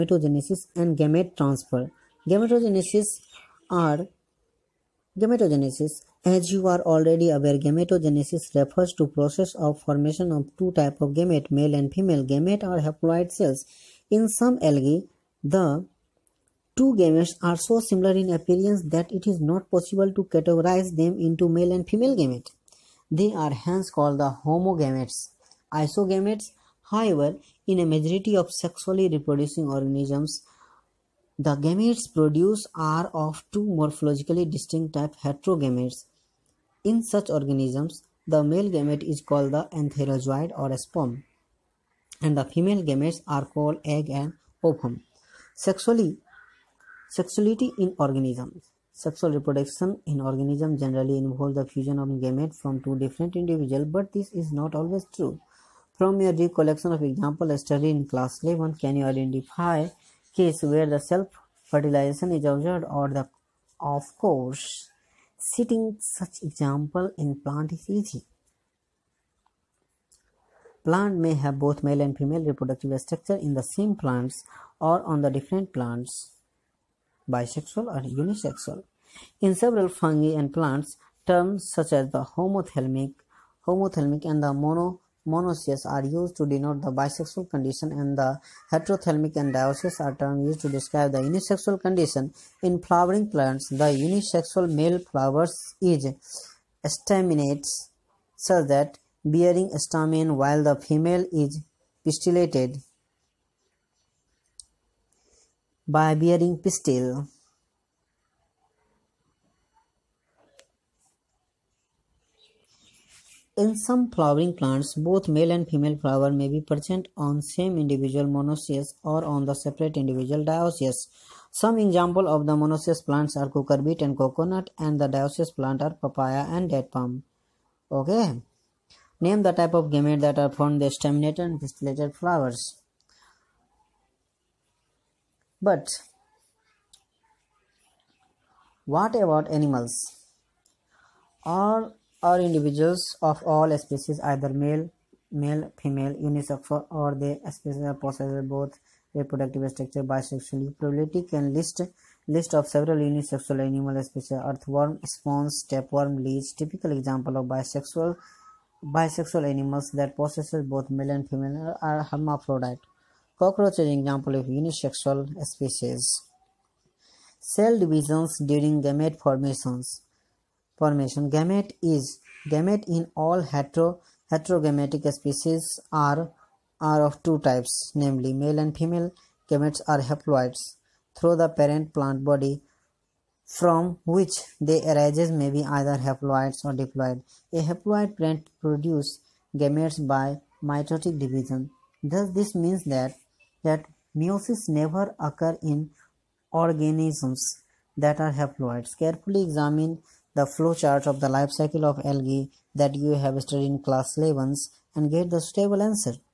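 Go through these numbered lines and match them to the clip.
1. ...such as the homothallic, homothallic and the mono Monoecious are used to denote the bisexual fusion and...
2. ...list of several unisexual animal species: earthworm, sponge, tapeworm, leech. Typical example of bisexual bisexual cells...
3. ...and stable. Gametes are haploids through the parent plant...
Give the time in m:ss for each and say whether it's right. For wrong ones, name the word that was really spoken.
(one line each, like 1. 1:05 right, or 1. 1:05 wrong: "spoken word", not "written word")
1. 1:21 wrong: "condition", not "fusion"
2. 2:32 wrong: "animals", not "cells"
3. 2:58 wrong: "female", not "stable".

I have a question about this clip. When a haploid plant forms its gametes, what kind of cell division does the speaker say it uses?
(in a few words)
mitotic division.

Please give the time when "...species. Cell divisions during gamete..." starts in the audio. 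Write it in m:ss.
2:45.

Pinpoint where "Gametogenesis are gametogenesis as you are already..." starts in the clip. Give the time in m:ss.
0:02.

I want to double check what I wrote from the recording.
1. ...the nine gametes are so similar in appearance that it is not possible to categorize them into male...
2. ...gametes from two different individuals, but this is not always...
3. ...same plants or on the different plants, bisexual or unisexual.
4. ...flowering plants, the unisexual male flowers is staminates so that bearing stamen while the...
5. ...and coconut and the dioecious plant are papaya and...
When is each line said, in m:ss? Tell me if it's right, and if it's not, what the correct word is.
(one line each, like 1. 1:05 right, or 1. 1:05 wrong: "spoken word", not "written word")
1. 0:15 wrong: "two", not "nine"
2. 0:52 right
3. 1:13 right
4. 1:32 right
5. 2:04 right.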